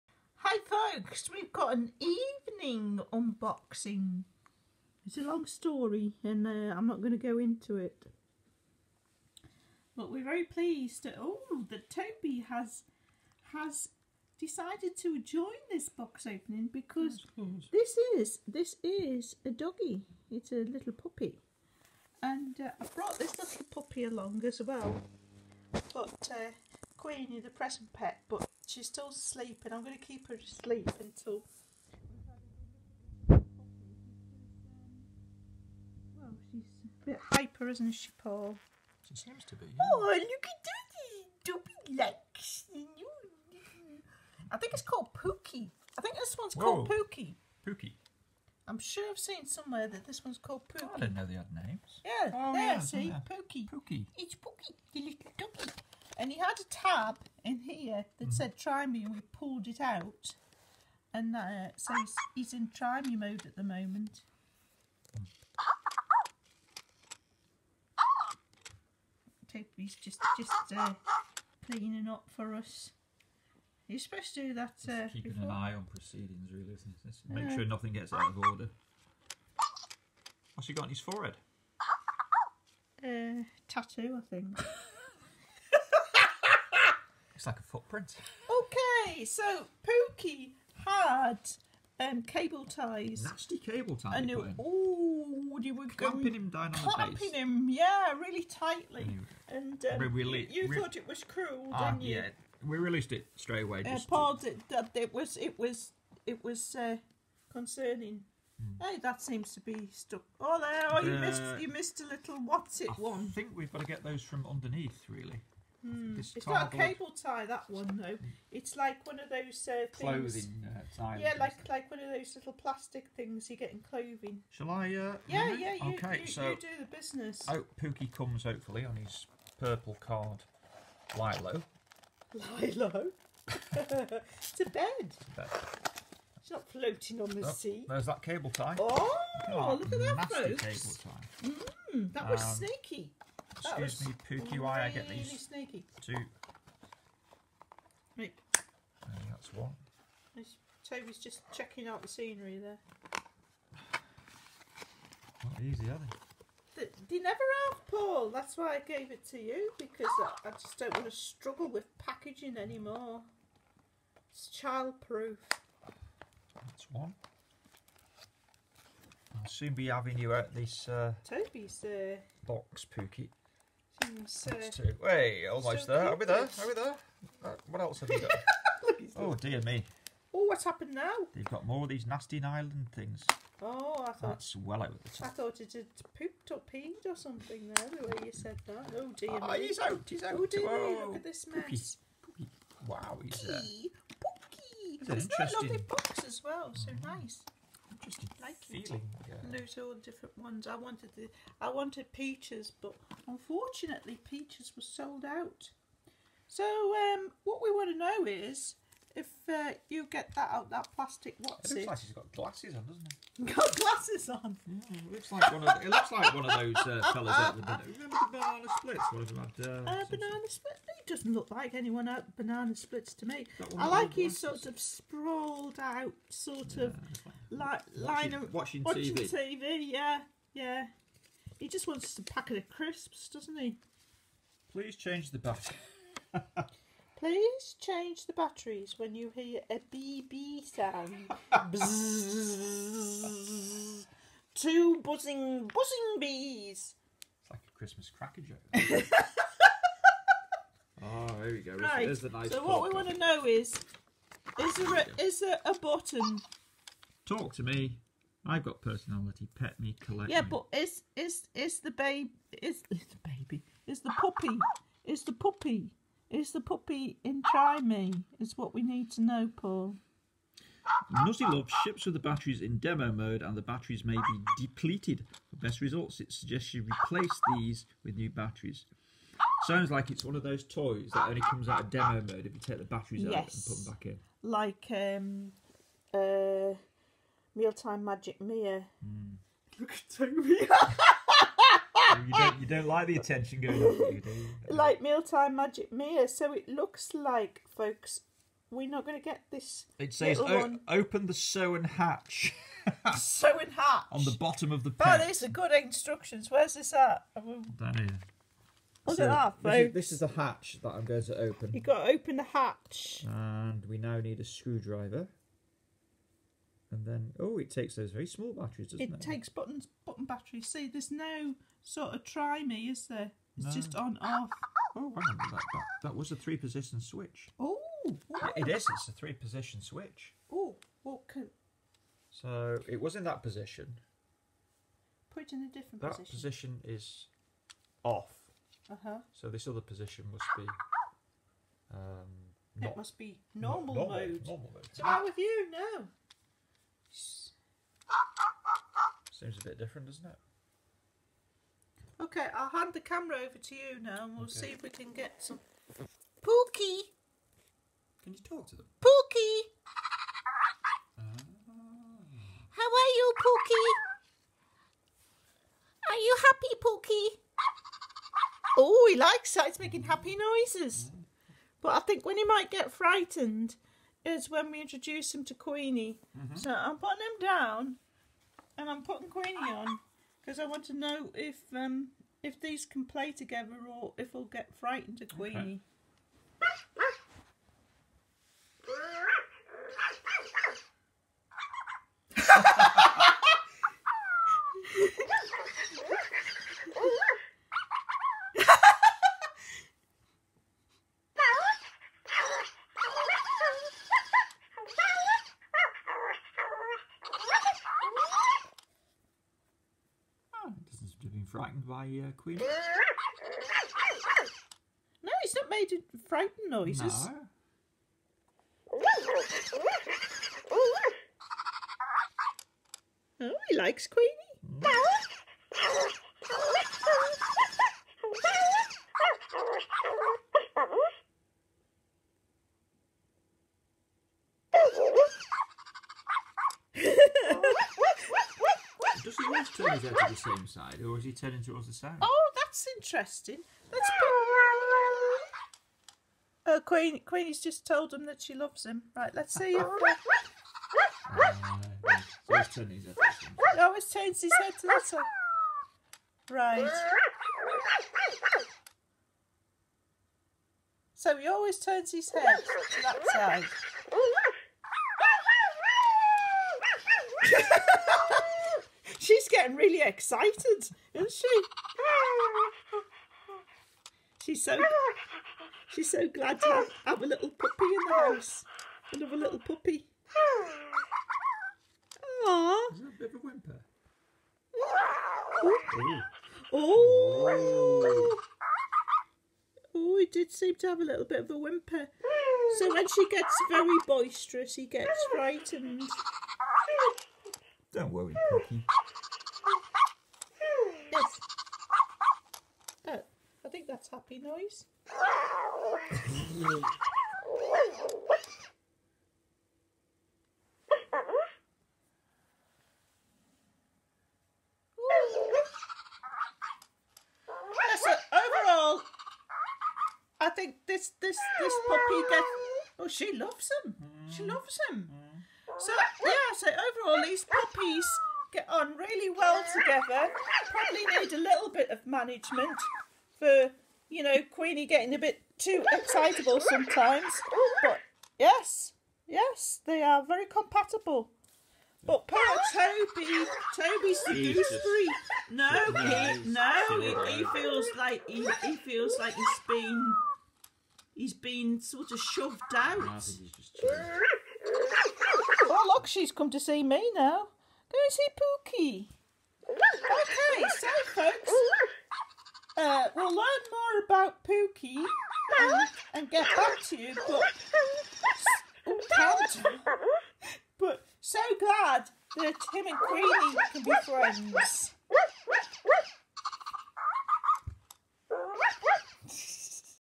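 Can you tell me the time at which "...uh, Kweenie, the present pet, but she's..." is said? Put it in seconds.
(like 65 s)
26 s.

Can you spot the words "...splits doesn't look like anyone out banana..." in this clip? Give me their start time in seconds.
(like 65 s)
220 s.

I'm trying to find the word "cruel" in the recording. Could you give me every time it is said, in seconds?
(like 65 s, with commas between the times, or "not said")
101 s.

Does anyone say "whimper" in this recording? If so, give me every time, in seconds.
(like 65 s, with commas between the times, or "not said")
483 s, 491 s.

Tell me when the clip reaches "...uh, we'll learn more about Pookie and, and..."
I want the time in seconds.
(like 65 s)
562 s.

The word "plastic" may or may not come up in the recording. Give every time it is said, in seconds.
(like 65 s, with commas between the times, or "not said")
122 s, 210 s.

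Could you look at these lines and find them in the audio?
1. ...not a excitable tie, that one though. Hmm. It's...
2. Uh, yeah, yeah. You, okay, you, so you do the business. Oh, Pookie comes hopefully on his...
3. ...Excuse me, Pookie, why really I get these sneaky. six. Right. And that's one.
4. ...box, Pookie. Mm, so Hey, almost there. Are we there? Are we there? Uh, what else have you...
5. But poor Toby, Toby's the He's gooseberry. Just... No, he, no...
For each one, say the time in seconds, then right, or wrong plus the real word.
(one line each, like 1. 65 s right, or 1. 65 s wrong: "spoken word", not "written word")
1. 116 s wrong: "cable", not "excitable"
2. 124 s right
3. 143 s wrong: "two", not "six"
4. 172 s right
5. 542 s right.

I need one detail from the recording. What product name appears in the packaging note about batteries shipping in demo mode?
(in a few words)
Nuzzy Luvs.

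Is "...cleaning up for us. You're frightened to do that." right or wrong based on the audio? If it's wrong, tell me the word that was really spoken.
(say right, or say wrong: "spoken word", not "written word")
wrong: "supposed", not "frightened".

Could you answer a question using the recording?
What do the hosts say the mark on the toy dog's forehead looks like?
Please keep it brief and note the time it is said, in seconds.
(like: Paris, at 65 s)
a footprint, at 87 s.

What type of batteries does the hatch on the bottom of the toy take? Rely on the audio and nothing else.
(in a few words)
button batteries.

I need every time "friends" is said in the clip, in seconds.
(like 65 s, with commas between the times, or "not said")
574 s.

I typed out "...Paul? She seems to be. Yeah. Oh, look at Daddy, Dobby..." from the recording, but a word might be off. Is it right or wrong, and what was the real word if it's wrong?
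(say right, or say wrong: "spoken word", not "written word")
right.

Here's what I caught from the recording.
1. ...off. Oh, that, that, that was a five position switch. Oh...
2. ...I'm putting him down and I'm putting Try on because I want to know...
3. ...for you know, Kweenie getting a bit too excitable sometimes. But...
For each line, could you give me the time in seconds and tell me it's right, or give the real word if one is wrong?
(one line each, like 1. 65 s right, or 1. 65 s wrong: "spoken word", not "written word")
1. 324 s wrong: "three", not "five"
2. 376 s wrong: "Kweenie", not "Try"
3. 533 s right.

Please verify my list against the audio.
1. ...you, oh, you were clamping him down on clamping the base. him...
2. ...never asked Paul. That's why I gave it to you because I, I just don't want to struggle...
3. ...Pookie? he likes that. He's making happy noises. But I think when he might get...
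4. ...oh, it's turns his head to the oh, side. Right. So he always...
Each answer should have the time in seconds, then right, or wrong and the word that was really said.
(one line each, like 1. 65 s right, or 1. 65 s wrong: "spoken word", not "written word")
1. 94 s right
2. 157 s right
3. 363 s right
4. 453 s right.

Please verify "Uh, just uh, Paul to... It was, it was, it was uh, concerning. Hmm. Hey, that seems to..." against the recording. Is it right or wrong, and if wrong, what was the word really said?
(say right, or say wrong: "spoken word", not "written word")
right.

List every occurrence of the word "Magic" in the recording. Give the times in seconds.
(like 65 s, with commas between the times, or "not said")
288 s, 295 s.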